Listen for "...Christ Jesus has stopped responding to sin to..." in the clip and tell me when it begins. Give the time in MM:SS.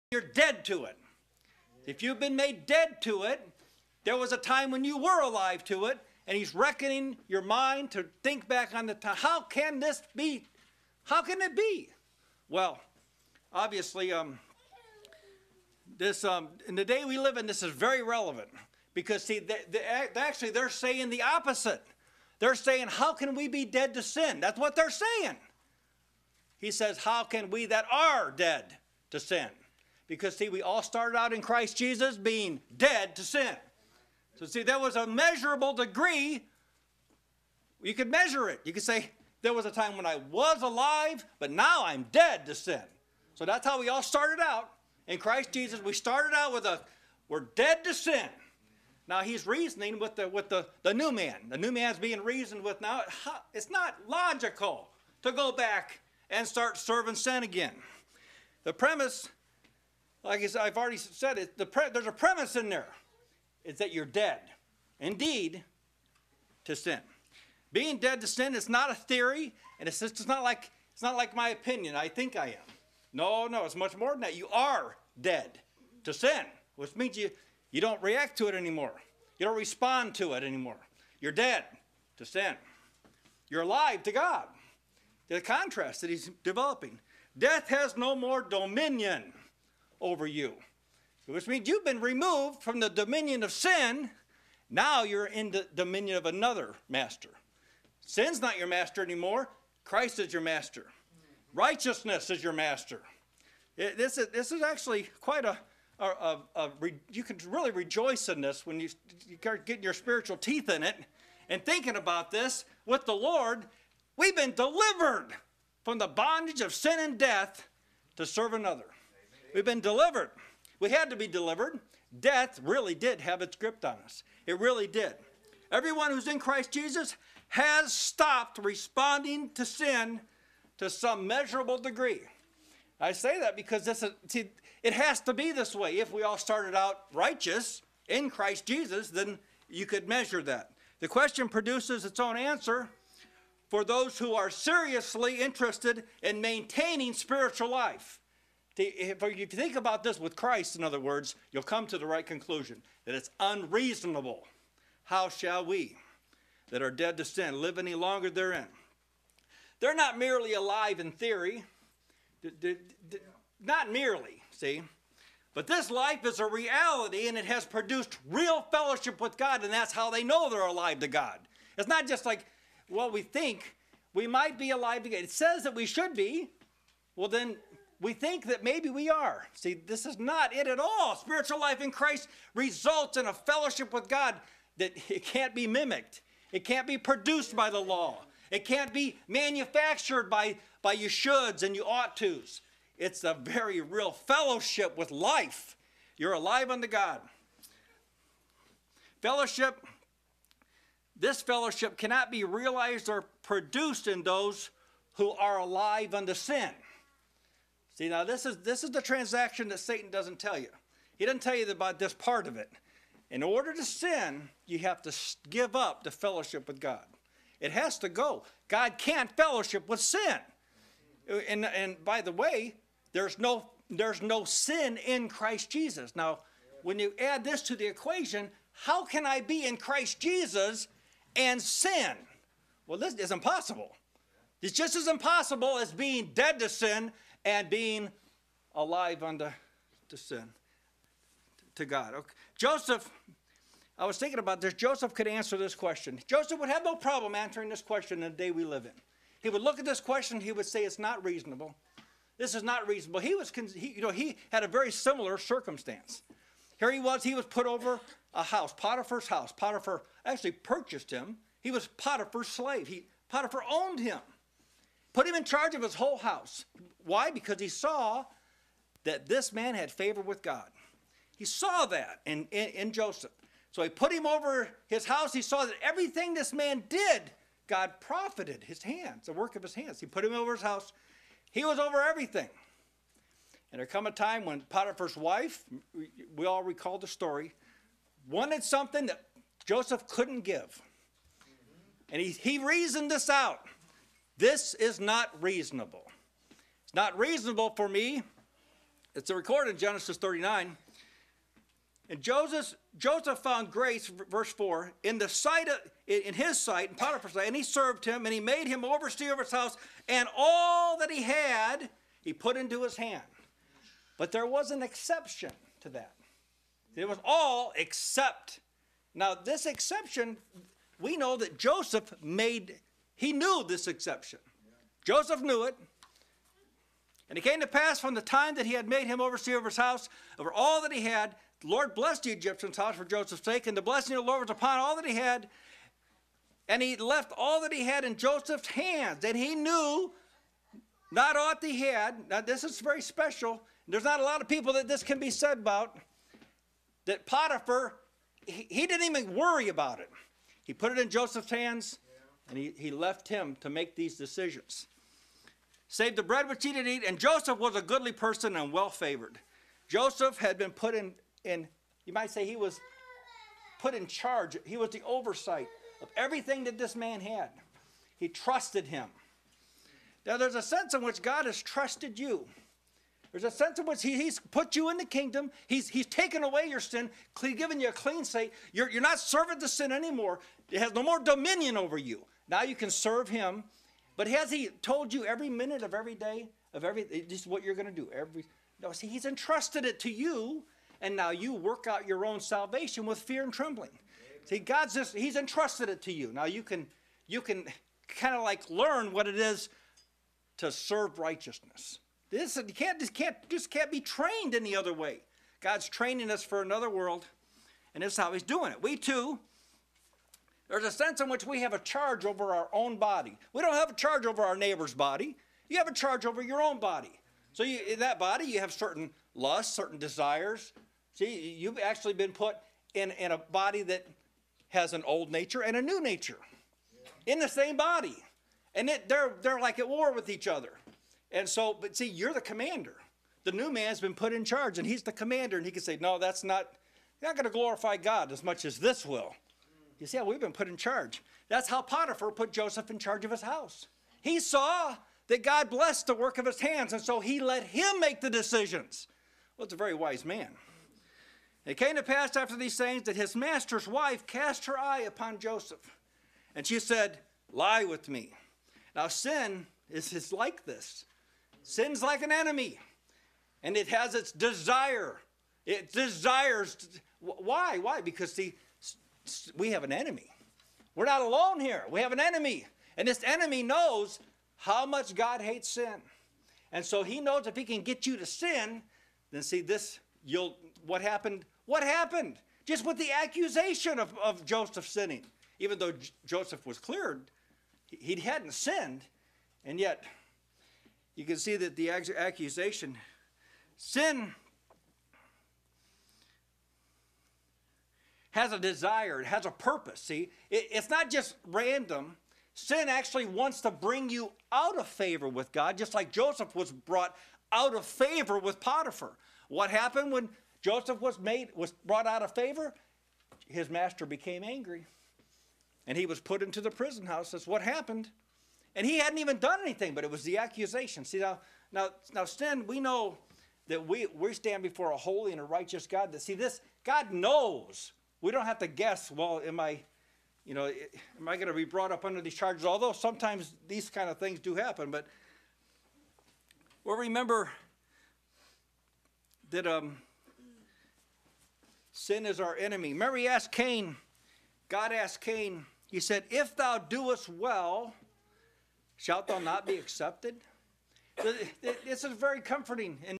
02:06.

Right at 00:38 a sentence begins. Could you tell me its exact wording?
You could say, there was a time when I was alive, but now I'm dead to sin.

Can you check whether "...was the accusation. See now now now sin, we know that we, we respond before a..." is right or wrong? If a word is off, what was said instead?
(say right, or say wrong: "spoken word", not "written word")
wrong: "stand", not "respond".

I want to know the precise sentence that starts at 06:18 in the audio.
You're, you're not serving to sin anymore.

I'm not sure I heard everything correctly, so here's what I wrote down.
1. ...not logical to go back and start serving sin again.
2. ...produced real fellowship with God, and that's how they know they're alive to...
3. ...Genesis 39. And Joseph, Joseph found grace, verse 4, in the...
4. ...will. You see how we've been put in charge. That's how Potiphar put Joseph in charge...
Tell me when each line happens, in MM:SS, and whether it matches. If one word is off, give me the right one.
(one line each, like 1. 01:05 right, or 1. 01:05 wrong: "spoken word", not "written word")
1. 00:53 right
2. 02:47 right
3. 04:59 right
4. 07:19 right.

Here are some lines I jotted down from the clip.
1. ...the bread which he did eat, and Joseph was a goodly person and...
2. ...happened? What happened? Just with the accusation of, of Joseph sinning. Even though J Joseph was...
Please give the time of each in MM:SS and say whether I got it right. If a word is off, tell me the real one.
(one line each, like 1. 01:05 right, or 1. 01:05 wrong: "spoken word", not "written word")
1. 05:56 right
2. 08:01 right.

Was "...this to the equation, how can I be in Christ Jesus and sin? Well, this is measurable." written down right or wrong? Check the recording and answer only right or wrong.
wrong.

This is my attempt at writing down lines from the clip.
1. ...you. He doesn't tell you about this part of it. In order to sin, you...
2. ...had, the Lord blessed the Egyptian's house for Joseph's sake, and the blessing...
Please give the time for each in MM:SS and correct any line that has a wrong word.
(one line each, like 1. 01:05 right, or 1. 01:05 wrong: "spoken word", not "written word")
1. 03:30 right
2. 05:31 right.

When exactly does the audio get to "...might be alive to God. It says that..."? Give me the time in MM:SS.
02:54.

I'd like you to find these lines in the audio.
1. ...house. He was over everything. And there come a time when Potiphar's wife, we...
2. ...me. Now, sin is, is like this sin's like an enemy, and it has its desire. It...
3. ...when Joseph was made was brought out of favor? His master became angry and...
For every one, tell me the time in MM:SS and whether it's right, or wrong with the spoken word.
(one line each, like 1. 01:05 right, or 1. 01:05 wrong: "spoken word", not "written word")
1. 04:40 right
2. 07:38 right
3. 08:30 right.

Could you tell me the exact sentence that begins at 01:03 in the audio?
It's that you're dead, indeed, to sin.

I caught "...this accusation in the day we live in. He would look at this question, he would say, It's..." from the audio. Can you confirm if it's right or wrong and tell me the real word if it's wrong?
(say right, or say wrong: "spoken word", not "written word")
wrong: "question", not "accusation".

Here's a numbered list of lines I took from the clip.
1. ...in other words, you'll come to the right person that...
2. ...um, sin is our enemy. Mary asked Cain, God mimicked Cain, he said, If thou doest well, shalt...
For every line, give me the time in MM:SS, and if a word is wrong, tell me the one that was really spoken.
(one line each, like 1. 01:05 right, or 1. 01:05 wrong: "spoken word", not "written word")
1. 02:30 wrong: "conclusion", not "person"
2. 08:59 wrong: "asked", not "mimicked".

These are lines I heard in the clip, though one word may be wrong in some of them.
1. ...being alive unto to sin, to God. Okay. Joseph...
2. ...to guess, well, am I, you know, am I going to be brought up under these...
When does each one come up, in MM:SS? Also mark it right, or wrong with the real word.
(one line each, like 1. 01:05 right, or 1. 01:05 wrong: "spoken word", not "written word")
1. 03:57 right
2. 08:48 right.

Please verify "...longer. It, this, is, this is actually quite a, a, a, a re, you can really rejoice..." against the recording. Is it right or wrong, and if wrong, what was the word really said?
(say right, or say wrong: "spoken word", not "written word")
wrong: "master", not "longer".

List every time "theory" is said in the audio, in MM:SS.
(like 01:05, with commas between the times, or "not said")
01:08, 02:41.